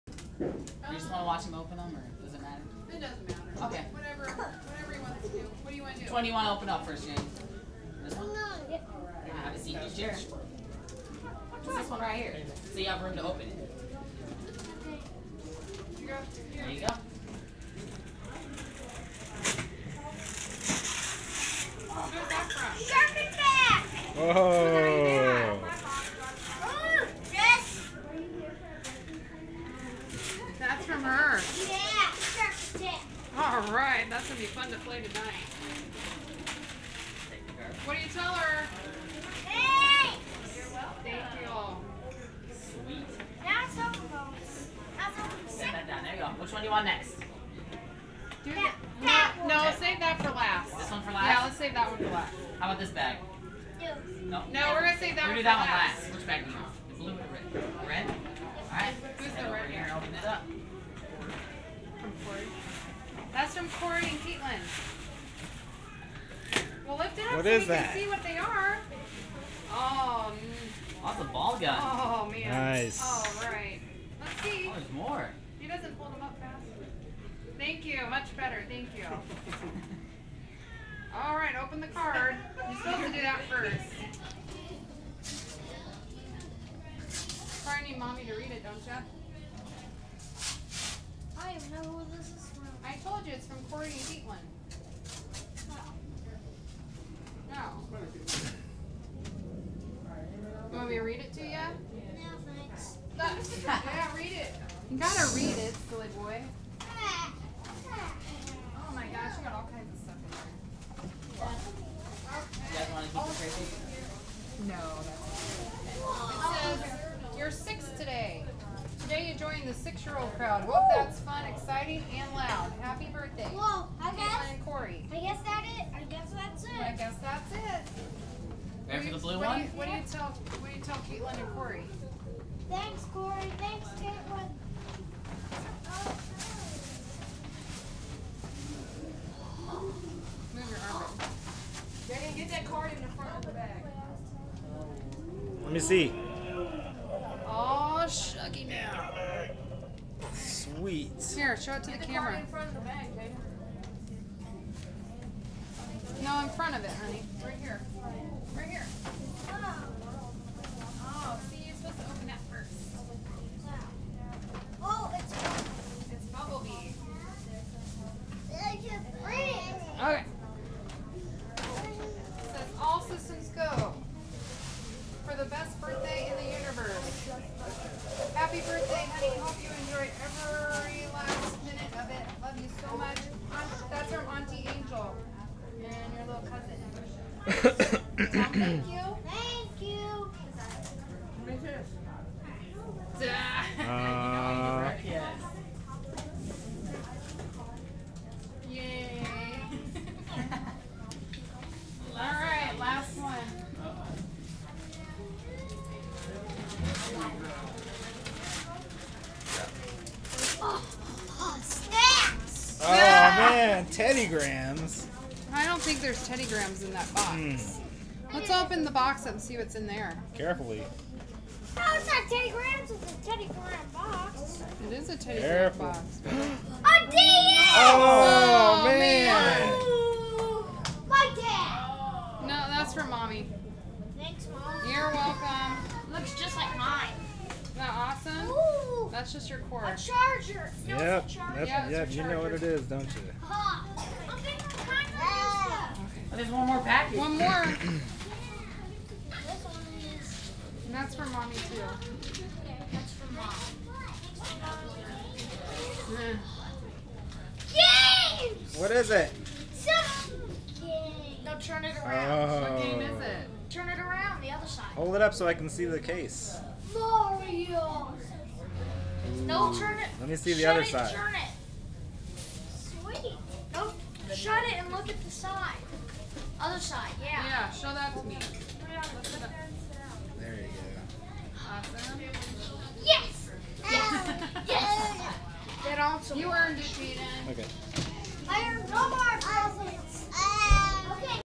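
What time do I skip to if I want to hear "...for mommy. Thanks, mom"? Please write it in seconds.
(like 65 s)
232 s.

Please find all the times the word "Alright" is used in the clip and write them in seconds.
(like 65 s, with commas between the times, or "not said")
33 s, 58 s.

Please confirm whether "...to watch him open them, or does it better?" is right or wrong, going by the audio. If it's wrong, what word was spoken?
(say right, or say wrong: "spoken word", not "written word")
wrong: "matter", not "better".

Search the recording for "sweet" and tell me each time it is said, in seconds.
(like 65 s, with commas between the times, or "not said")
42 s, 150 s, 272 s.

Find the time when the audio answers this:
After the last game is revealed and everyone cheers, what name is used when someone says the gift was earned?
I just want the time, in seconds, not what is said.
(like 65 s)
286 s.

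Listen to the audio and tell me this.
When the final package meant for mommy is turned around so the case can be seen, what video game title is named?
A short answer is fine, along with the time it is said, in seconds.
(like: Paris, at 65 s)
Mario, at 266 s.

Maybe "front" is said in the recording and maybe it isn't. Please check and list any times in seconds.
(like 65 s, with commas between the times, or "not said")
143 s, 152 s, 156 s.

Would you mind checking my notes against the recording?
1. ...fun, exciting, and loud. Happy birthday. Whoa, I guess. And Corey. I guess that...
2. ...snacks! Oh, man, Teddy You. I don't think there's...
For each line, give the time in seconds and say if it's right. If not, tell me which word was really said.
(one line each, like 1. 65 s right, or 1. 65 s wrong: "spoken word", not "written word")
1. 121 s right
2. 211 s wrong: "Grahams", not "You".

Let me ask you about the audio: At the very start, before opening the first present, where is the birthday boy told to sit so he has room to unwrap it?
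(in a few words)
chair.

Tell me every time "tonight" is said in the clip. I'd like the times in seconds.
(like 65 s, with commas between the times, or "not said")
34 s.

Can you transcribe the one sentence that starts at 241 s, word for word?
That's, yeah, yep, you know what it is, don't you?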